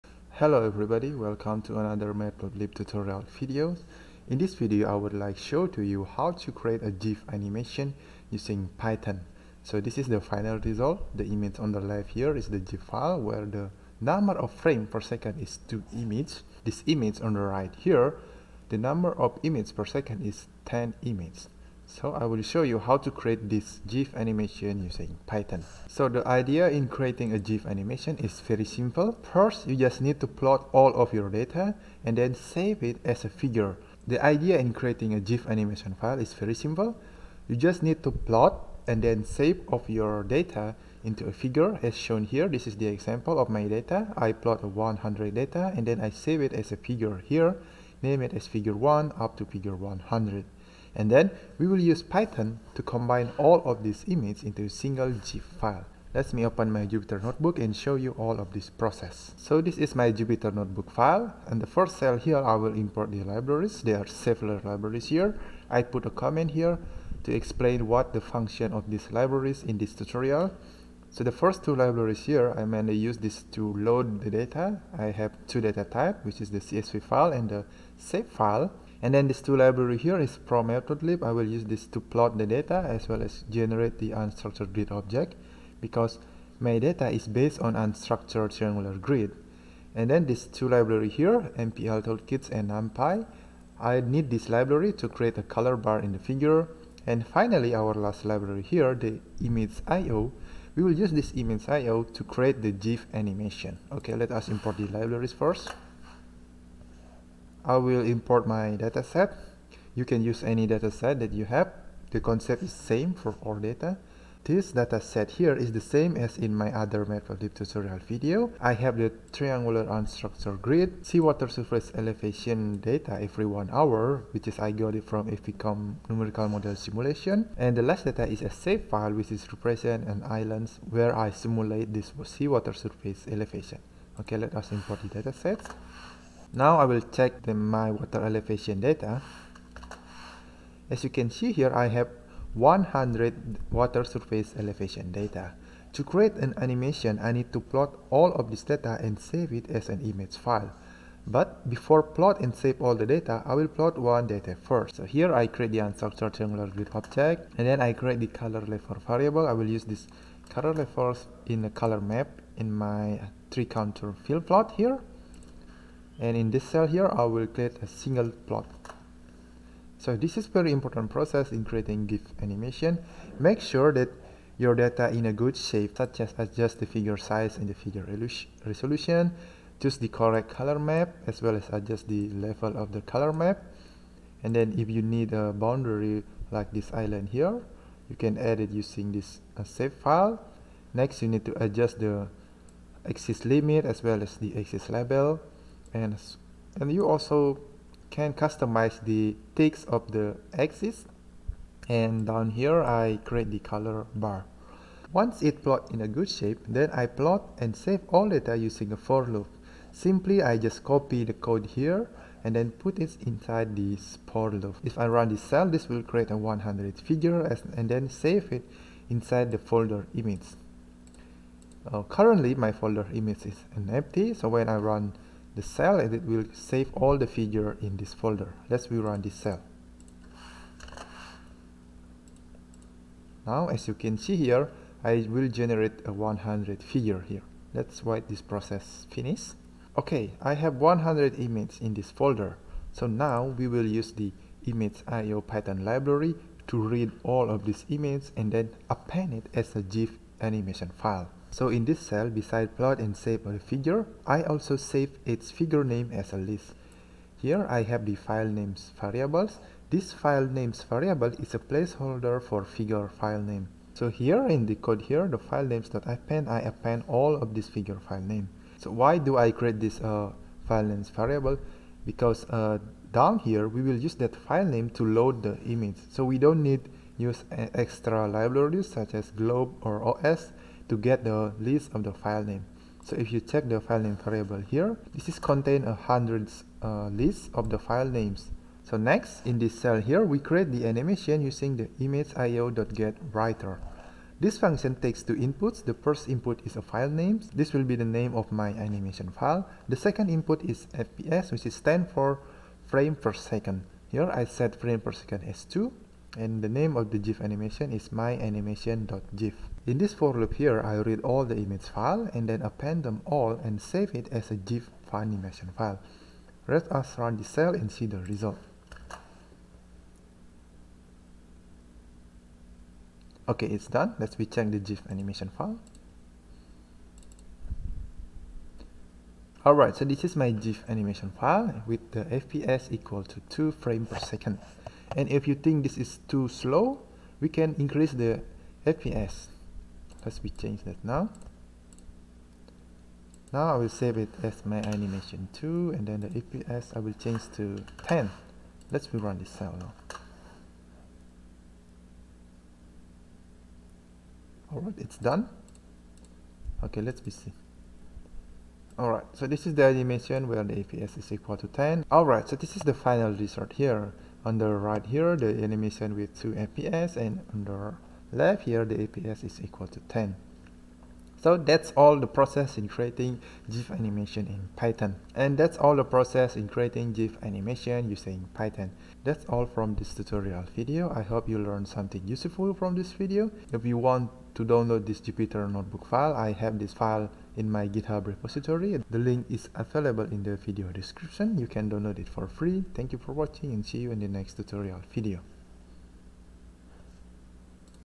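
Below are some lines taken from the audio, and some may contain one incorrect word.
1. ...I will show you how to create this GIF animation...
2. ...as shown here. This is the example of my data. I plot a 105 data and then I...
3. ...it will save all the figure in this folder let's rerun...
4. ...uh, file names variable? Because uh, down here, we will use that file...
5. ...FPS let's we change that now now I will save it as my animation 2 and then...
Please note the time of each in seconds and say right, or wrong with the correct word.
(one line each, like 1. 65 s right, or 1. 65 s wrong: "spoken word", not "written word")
1. 22 s right
2. 41 s wrong: "100", not "105"
3. 226 s right
4. 269 s right
5. 338 s right.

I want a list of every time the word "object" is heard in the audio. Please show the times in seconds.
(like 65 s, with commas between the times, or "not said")
84 s, 156 s.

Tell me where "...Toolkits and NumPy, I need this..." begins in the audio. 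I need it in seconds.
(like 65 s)
92 s.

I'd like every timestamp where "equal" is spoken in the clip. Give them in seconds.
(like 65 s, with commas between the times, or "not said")
332 s, 361 s, 369 s.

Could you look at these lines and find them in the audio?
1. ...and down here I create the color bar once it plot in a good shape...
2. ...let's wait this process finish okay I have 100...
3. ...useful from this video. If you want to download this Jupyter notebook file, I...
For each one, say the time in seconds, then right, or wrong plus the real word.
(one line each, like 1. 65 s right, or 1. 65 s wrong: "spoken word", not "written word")
1. 201 s right
2. 237 s right
3. 382 s right.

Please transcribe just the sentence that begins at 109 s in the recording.
You can use any dataset that you have.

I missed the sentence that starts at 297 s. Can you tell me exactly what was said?
This will be the name of my animation file.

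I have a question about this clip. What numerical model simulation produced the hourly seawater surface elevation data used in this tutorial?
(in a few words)
FVCOM.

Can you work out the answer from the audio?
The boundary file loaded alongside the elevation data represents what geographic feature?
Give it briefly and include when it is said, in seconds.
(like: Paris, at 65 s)
islands, at 130 s.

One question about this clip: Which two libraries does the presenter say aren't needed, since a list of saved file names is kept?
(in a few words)
glob or OS.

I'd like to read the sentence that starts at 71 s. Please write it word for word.
So the first two libraries here, I mainly use this to load the data.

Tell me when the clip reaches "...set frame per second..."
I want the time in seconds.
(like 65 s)
304 s.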